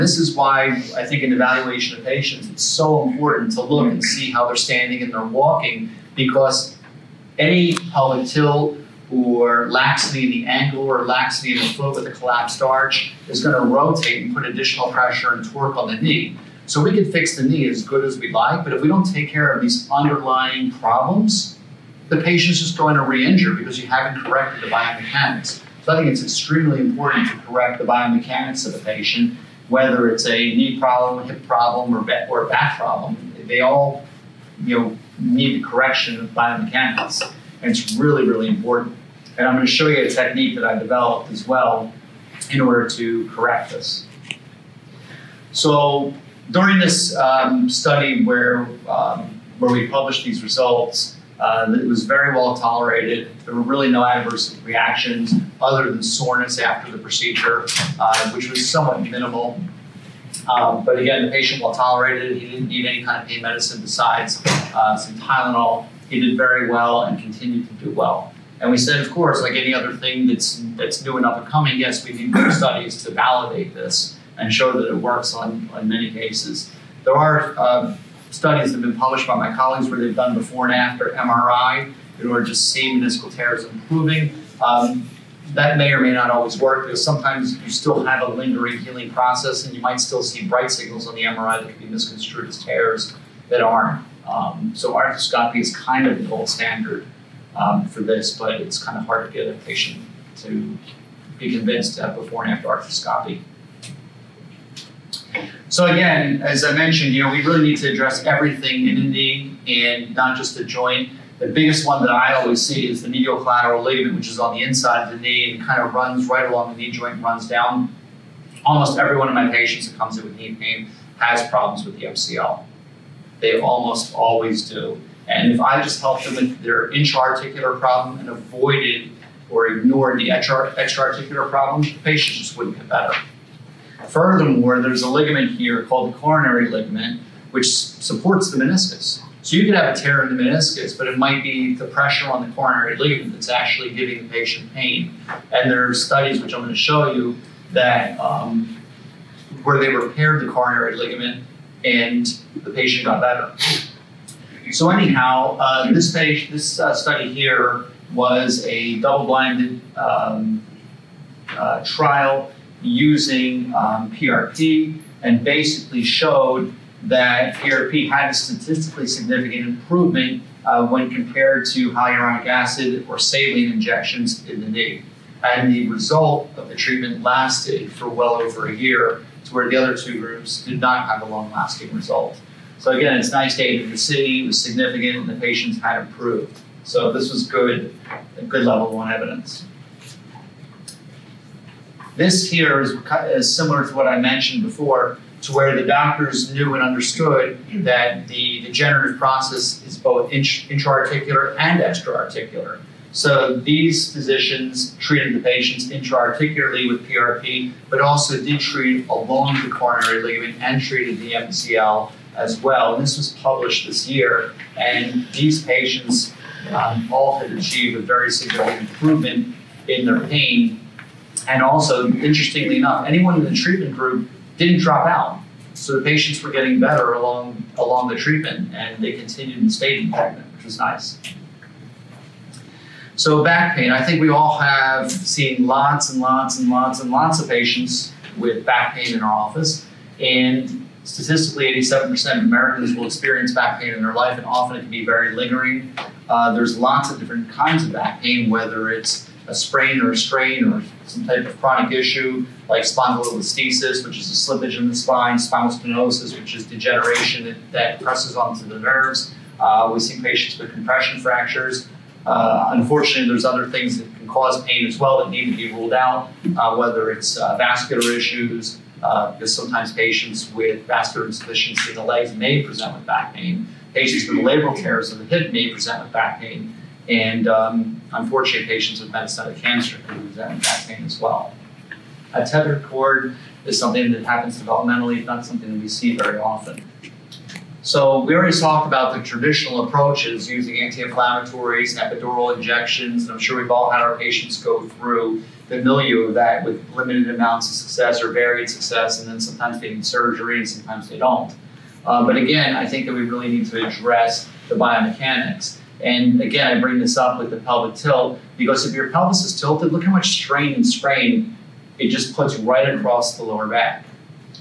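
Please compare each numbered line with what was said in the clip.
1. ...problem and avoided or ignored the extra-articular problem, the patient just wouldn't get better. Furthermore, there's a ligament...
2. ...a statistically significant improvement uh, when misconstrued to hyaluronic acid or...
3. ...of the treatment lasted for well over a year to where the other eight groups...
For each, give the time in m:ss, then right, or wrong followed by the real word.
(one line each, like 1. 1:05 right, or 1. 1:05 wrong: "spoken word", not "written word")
1. 2:07 right
2. 2:48 wrong: "compared", not "misconstrued"
3. 2:56 wrong: "two", not "eight".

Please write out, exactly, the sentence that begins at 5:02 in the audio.
Uh, but again, I think that we really need to address the biomechanics.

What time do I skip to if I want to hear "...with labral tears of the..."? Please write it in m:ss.
4:34.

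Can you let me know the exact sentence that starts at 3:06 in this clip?
So this was good, good level one evidence.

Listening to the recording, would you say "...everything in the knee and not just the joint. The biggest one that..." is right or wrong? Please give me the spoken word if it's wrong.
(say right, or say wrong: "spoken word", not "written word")
right.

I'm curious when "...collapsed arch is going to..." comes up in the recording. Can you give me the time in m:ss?
0:12.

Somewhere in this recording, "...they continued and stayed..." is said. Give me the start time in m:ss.
3:49.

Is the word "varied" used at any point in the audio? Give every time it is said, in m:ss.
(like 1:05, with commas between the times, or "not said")
4:58.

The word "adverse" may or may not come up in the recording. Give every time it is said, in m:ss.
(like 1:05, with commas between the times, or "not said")
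0:54.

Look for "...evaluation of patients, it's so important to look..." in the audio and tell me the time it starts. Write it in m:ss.
0:01.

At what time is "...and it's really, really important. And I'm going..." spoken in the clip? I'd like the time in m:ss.
0:37.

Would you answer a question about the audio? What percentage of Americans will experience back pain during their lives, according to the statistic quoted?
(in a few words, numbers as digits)
87%.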